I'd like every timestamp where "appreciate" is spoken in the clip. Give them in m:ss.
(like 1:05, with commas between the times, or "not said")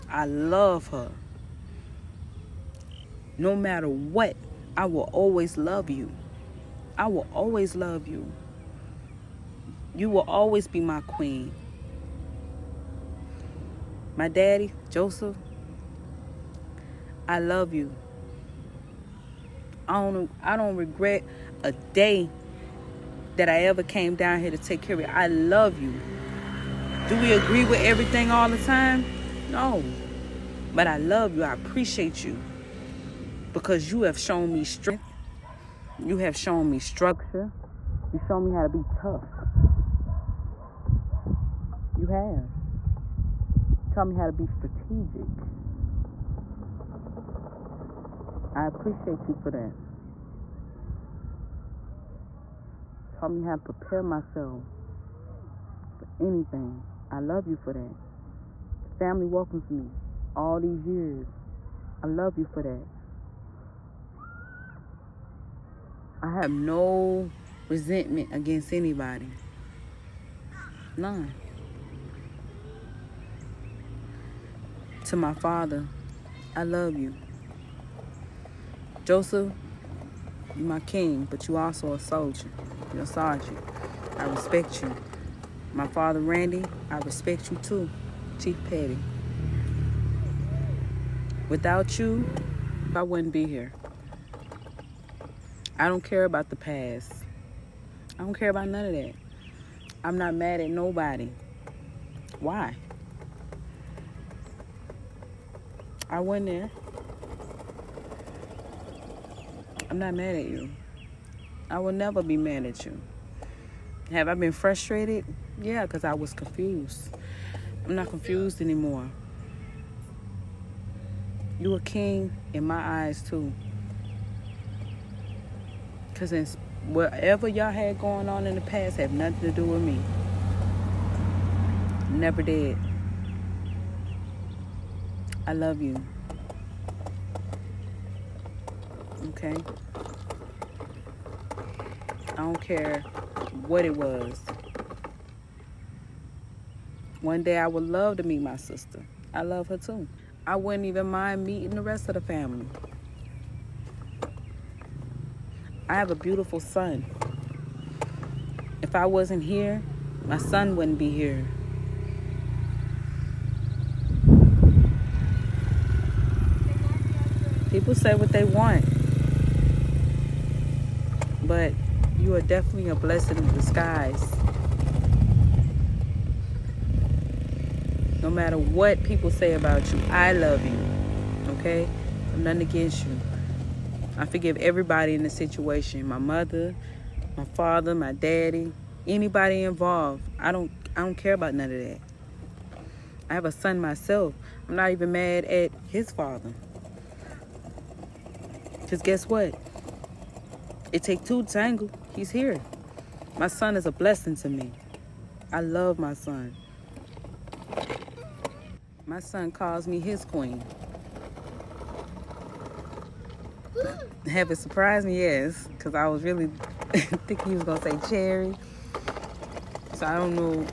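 0:31, 0:48.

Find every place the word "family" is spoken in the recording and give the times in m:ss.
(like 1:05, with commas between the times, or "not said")
0:59, 2:32.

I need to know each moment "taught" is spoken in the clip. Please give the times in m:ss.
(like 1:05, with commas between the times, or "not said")
0:43, 0:53.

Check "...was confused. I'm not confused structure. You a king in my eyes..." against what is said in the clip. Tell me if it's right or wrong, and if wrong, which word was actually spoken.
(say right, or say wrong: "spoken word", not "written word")
wrong: "anymore", not "structure".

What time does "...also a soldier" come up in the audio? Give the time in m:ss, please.
1:21.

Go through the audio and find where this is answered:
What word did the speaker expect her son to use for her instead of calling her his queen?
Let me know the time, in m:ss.
3:38.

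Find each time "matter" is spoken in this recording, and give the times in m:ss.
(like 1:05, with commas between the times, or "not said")
0:03, 2:58.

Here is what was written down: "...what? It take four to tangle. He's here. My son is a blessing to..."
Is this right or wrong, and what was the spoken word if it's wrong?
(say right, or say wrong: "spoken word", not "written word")
wrong: "two", not "four".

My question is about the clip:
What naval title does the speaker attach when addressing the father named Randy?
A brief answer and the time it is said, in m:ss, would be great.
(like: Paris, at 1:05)
Chief Petty, at 1:28.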